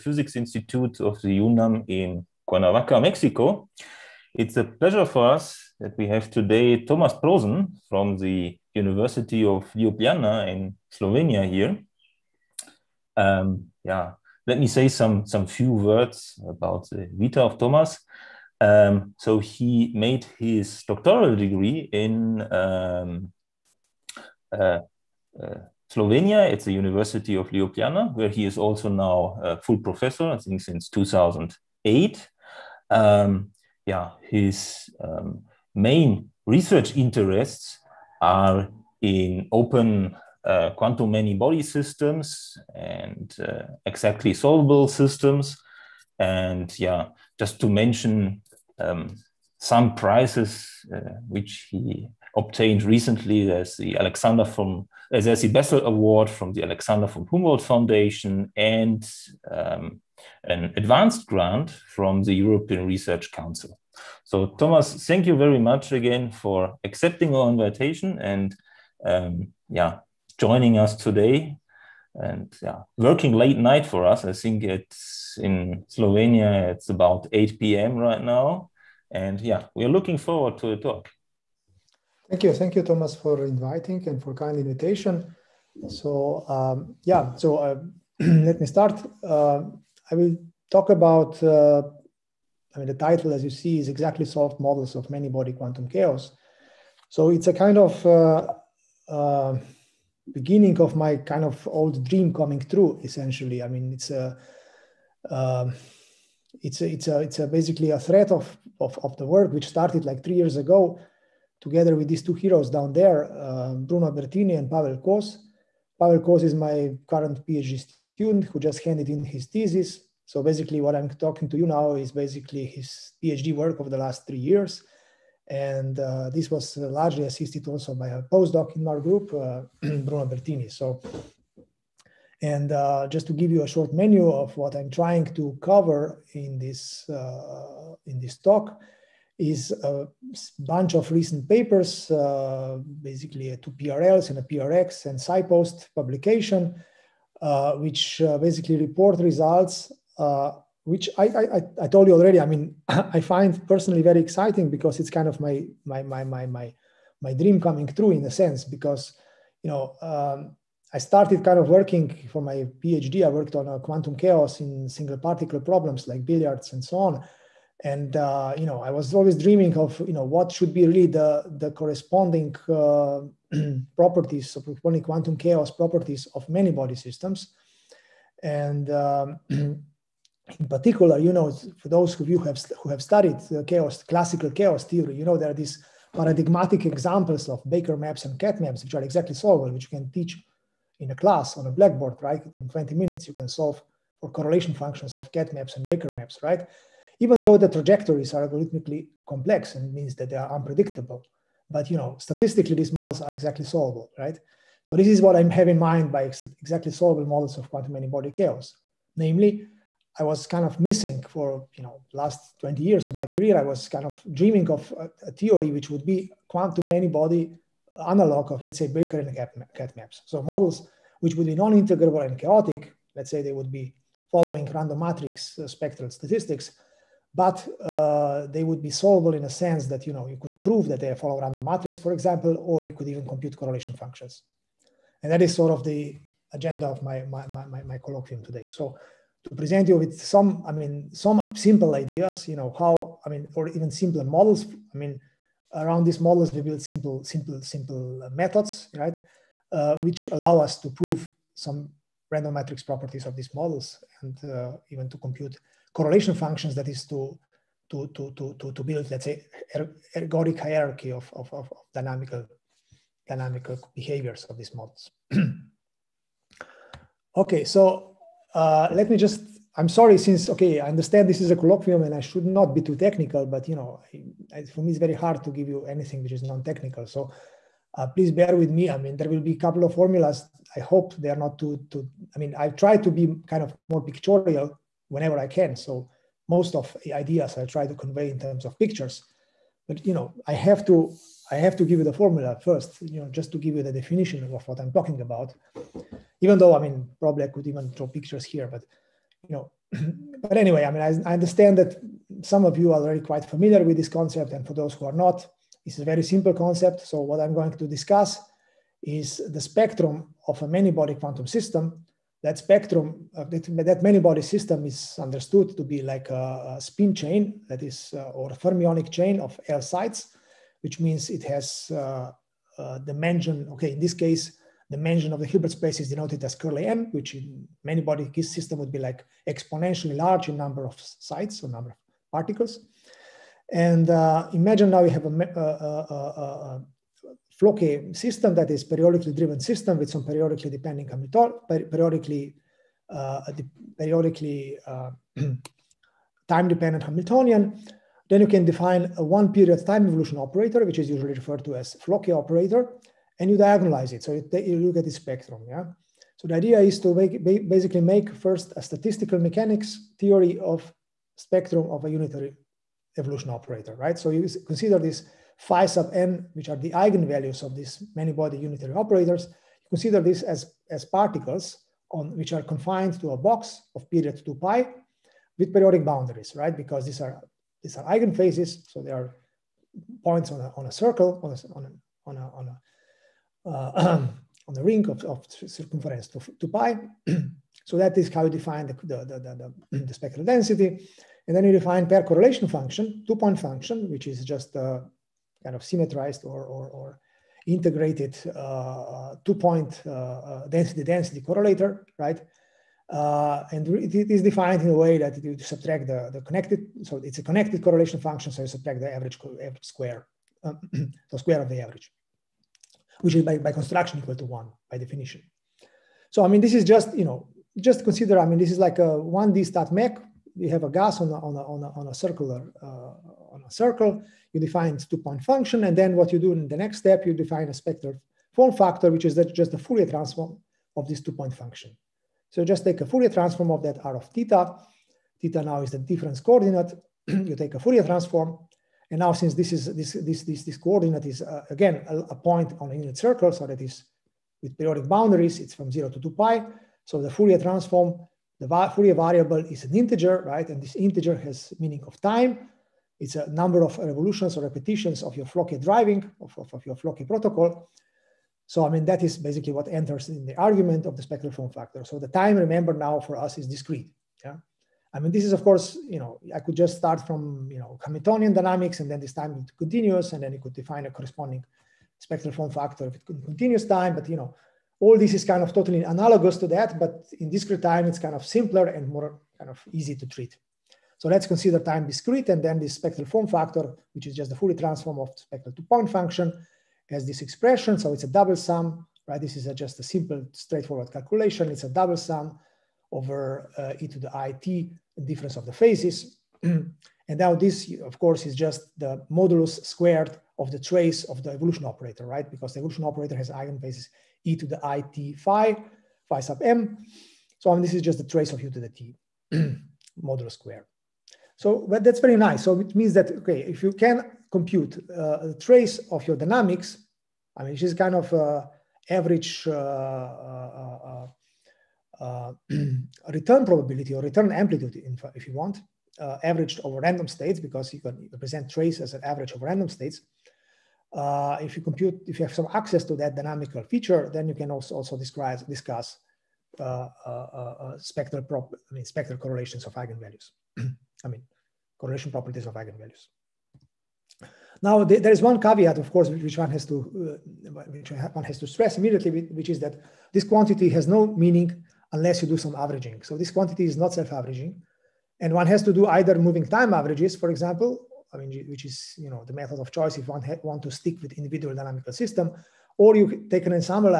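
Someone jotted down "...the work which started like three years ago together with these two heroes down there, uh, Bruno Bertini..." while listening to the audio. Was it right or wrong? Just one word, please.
right.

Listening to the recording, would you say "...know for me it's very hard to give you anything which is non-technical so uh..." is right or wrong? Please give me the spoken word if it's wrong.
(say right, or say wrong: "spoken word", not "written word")
right.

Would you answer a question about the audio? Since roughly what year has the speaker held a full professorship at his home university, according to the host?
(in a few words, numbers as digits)
2008.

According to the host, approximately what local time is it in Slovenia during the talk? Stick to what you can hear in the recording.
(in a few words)
8 p.m.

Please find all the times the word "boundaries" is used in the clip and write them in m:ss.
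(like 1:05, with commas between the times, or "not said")
6:16, 7:25.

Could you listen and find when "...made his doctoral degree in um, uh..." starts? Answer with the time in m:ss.
0:19.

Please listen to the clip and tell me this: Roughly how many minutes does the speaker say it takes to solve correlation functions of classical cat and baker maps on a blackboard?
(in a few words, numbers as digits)
20.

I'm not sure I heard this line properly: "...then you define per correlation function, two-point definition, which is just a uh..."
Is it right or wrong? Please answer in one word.
wrong.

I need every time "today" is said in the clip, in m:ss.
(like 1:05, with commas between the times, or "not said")
0:06, 1:10, 3:58.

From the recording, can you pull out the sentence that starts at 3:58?
So to present you with some, I mean, some simple ideas, you know, how I mean, or even simpler models.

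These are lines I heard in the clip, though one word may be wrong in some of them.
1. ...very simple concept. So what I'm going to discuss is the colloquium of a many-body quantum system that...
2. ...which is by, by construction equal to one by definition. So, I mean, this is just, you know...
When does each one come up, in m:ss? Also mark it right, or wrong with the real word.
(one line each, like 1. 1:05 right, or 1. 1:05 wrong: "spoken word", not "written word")
1. 5:06 wrong: "spectrum", not "colloquium"
2. 6:53 right.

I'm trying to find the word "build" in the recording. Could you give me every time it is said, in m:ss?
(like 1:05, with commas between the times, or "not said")
4:06, 4:18.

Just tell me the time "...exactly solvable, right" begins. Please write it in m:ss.
3:23.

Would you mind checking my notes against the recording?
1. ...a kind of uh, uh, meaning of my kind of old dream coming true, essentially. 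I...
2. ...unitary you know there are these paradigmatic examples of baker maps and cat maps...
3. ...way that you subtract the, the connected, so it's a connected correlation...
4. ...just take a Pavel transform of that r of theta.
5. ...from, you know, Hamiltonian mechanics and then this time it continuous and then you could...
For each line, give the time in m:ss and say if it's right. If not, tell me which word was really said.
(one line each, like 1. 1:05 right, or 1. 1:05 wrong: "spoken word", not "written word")
1. 1:37 wrong: "beginning", not "meaning"
2. 3:04 wrong: "theory", not "unitary"
3. 6:45 right
4. 7:12 wrong: "Fourier", not "Pavel"
5. 7:47 wrong: "dynamics", not "mechanics".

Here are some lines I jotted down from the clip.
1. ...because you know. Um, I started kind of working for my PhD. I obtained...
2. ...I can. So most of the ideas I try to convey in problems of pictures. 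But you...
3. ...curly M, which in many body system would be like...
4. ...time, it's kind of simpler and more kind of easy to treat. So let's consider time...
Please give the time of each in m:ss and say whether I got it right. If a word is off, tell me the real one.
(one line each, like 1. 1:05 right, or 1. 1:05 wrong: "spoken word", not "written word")
1. 2:38 wrong: "worked", not "obtained"
2. 4:45 wrong: "terms", not "problems"
3. 5:26 right
4. 7:57 right.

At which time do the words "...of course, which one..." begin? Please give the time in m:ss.
9:05.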